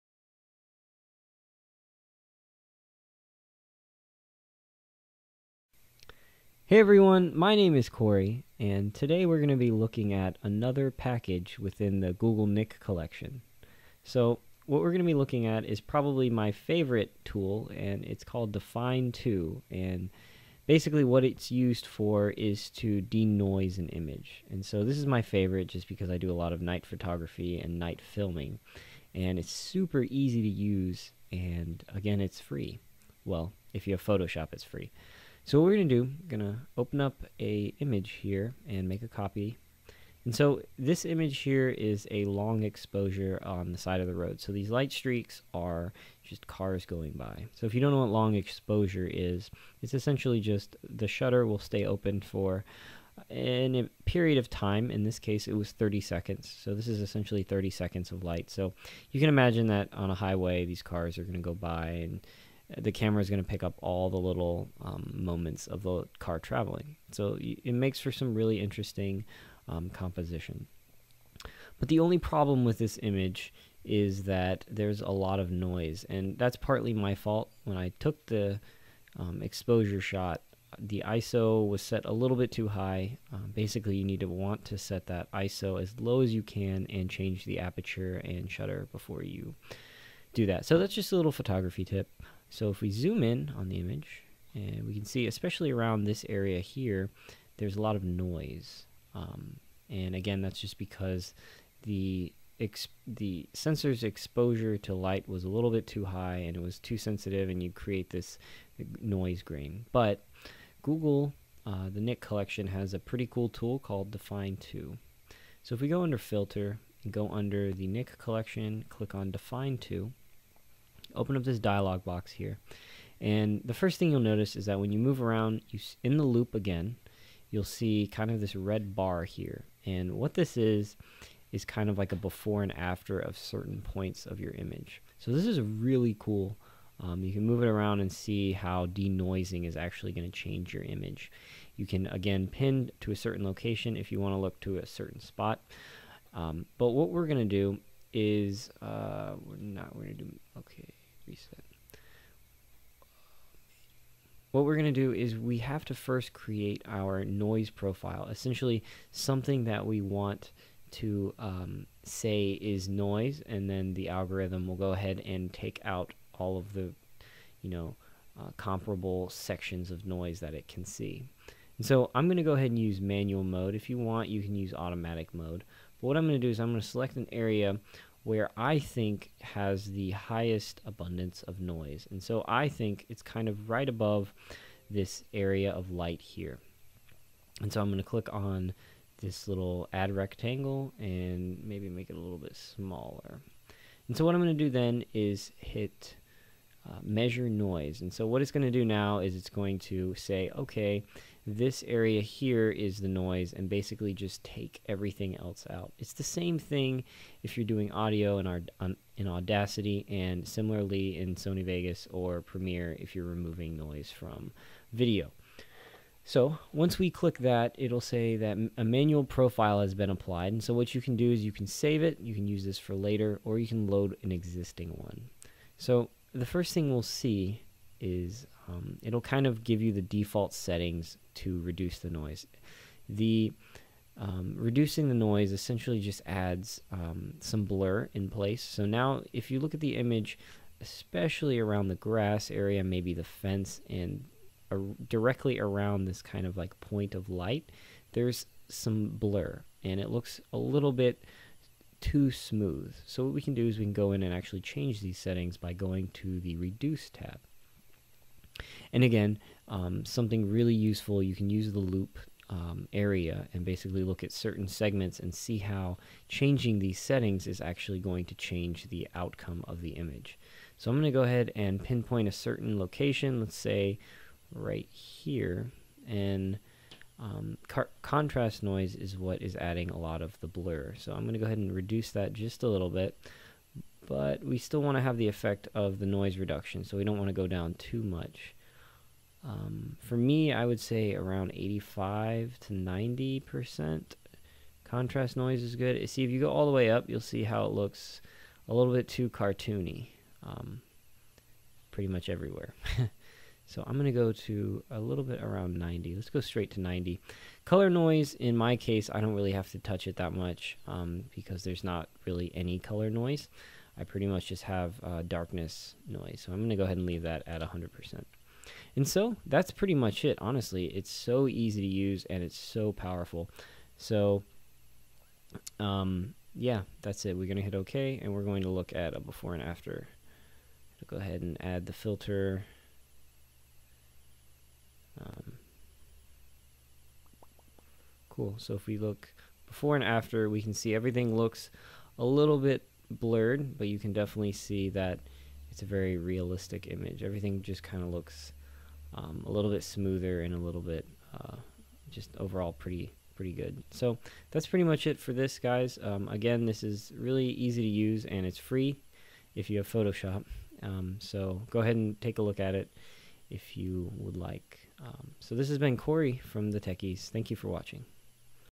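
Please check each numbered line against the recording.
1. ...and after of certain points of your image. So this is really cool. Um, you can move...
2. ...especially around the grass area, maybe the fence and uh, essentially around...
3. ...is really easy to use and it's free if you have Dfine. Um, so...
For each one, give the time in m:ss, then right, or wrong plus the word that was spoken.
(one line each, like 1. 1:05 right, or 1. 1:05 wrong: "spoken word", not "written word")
1. 2:12 right
2. 4:00 wrong: "directly", not "essentially"
3. 5:56 wrong: "Photoshop", not "Dfine".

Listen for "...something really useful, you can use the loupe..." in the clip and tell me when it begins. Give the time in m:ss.
4:20.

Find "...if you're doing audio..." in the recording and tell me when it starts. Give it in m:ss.
3:27.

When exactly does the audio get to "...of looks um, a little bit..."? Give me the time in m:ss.
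5:48.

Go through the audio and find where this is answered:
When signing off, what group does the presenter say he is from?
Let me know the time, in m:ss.
6:06.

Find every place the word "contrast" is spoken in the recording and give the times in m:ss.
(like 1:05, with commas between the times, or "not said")
4:38, 4:54.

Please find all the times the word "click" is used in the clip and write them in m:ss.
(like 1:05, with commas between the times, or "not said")
1:58, 3:08, 3:37.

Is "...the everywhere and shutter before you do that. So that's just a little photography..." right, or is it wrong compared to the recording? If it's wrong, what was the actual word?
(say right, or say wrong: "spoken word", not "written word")
wrong: "aperture", not "everywhere".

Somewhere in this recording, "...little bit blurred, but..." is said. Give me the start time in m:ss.
5:42.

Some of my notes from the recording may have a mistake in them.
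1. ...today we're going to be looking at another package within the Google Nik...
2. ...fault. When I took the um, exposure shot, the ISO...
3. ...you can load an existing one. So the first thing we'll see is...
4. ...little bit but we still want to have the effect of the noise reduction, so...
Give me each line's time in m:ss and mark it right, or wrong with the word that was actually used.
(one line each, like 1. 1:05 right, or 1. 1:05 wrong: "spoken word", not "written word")
1. 0:08 right
2. 1:17 right
3. 3:43 right
4. 4:42 right.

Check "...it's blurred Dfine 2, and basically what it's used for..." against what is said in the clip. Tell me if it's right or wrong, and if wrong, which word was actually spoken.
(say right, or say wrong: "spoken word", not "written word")
wrong: "called", not "blurred".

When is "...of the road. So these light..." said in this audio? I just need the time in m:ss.
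0:44.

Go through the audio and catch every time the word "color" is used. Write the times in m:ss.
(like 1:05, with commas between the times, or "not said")
5:07, 5:12.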